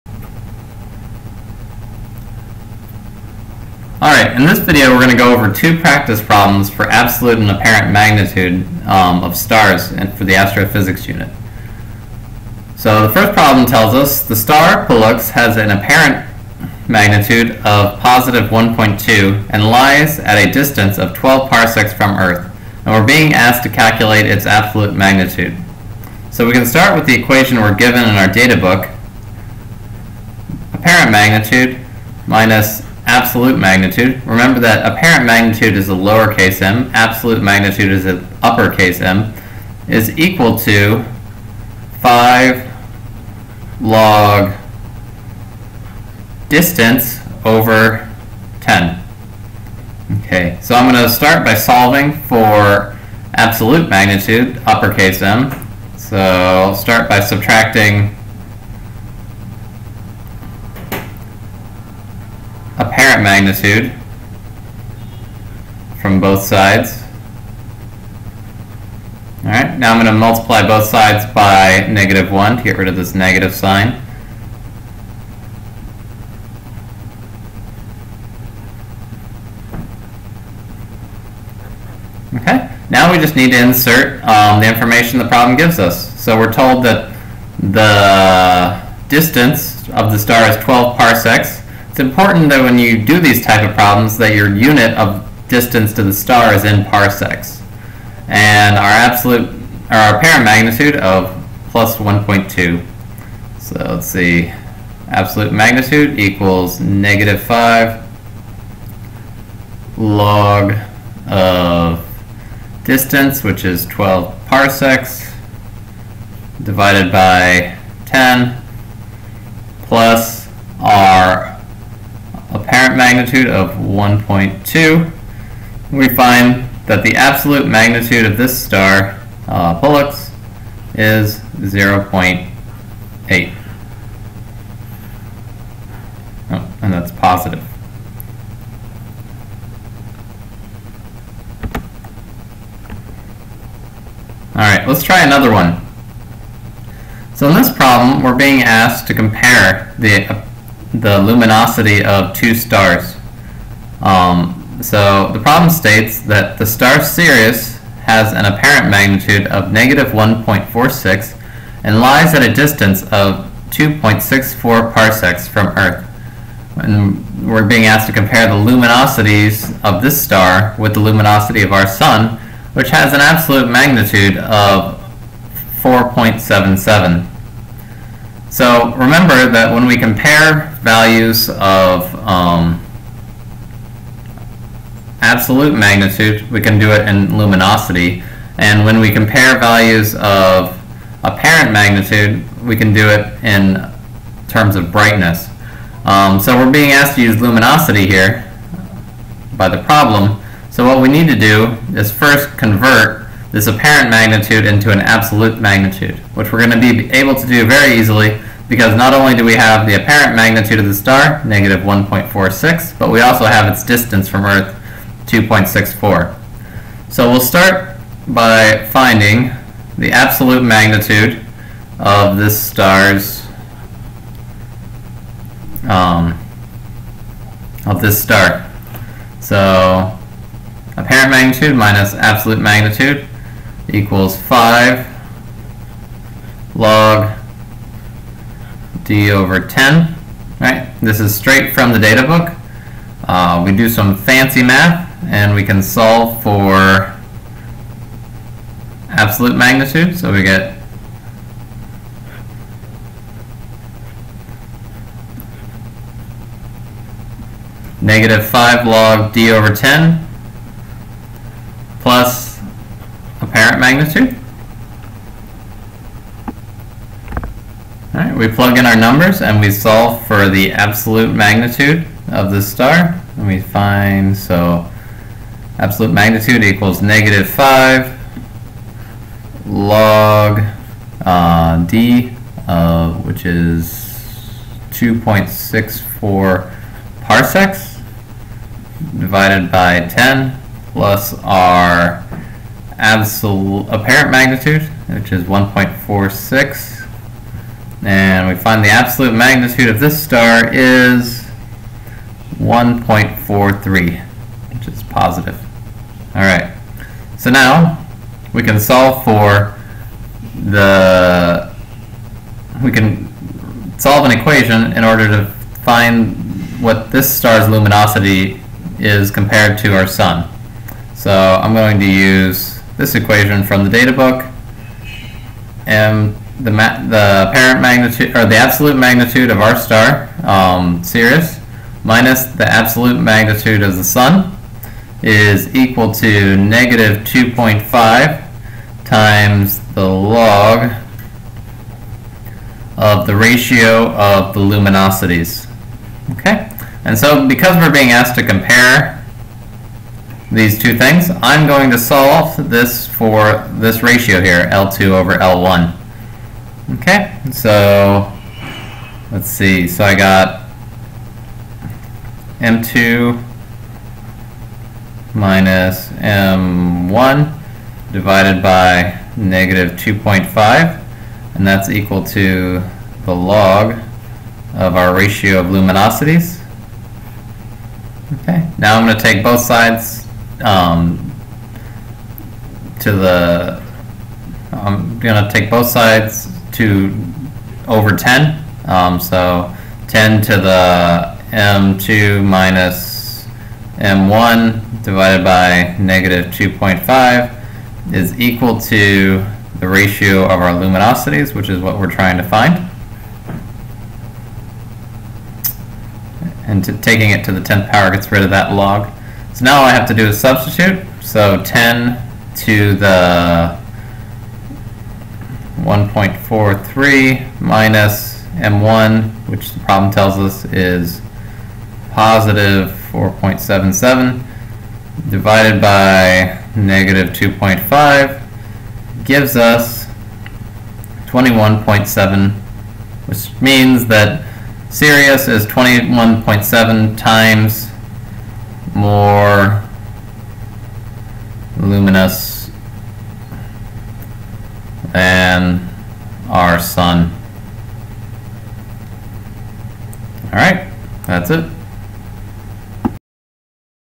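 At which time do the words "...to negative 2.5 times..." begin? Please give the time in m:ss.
5:36.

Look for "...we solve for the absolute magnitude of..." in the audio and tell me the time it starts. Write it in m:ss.
4:29.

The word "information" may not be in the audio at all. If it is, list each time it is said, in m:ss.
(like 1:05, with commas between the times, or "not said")
1:24.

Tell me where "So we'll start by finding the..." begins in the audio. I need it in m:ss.
3:37.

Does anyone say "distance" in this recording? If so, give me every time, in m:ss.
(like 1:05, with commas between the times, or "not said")
0:20, 0:46, 1:29, 1:35, 1:52, 2:42, 3:33.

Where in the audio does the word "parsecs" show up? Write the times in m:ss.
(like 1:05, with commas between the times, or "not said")
0:21, 1:30, 1:36, 1:54, 2:44, 4:47.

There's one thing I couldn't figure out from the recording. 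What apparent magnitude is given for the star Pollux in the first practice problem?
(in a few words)
+1.2.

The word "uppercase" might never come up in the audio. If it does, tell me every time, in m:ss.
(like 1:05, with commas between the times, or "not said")
0:38, 0:54.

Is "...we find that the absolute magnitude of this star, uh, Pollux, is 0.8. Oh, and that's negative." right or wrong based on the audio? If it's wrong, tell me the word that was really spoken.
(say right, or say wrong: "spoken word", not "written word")
wrong: "positive", not "negative".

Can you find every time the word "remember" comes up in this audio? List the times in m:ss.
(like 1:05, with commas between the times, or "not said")
0:34, 2:58.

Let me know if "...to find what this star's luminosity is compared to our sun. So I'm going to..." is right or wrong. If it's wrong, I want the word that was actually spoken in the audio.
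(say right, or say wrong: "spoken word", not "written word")
right.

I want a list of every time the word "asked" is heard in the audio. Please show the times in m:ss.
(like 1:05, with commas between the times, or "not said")
0:23, 2:28, 2:47, 3:16, 5:48.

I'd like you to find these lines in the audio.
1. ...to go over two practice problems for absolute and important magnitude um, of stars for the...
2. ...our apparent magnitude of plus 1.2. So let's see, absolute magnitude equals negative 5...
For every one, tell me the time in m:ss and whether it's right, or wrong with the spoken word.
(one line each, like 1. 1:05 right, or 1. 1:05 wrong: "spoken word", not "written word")
1. 0:05 wrong: "apparent", not "important"
2. 1:39 right.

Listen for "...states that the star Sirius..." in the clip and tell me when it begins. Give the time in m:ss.
2:35.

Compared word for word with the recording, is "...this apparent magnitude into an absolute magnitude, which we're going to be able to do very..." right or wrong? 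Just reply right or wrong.
right.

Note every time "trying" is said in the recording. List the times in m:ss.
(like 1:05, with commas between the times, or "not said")
6:42.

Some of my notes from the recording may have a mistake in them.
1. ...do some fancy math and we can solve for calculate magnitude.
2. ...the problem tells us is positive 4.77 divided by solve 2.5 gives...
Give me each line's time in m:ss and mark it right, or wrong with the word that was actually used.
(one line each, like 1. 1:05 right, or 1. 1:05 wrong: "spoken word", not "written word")
1. 4:03 wrong: "absolute", not "calculate"
2. 6:59 wrong: "negative", not "solve".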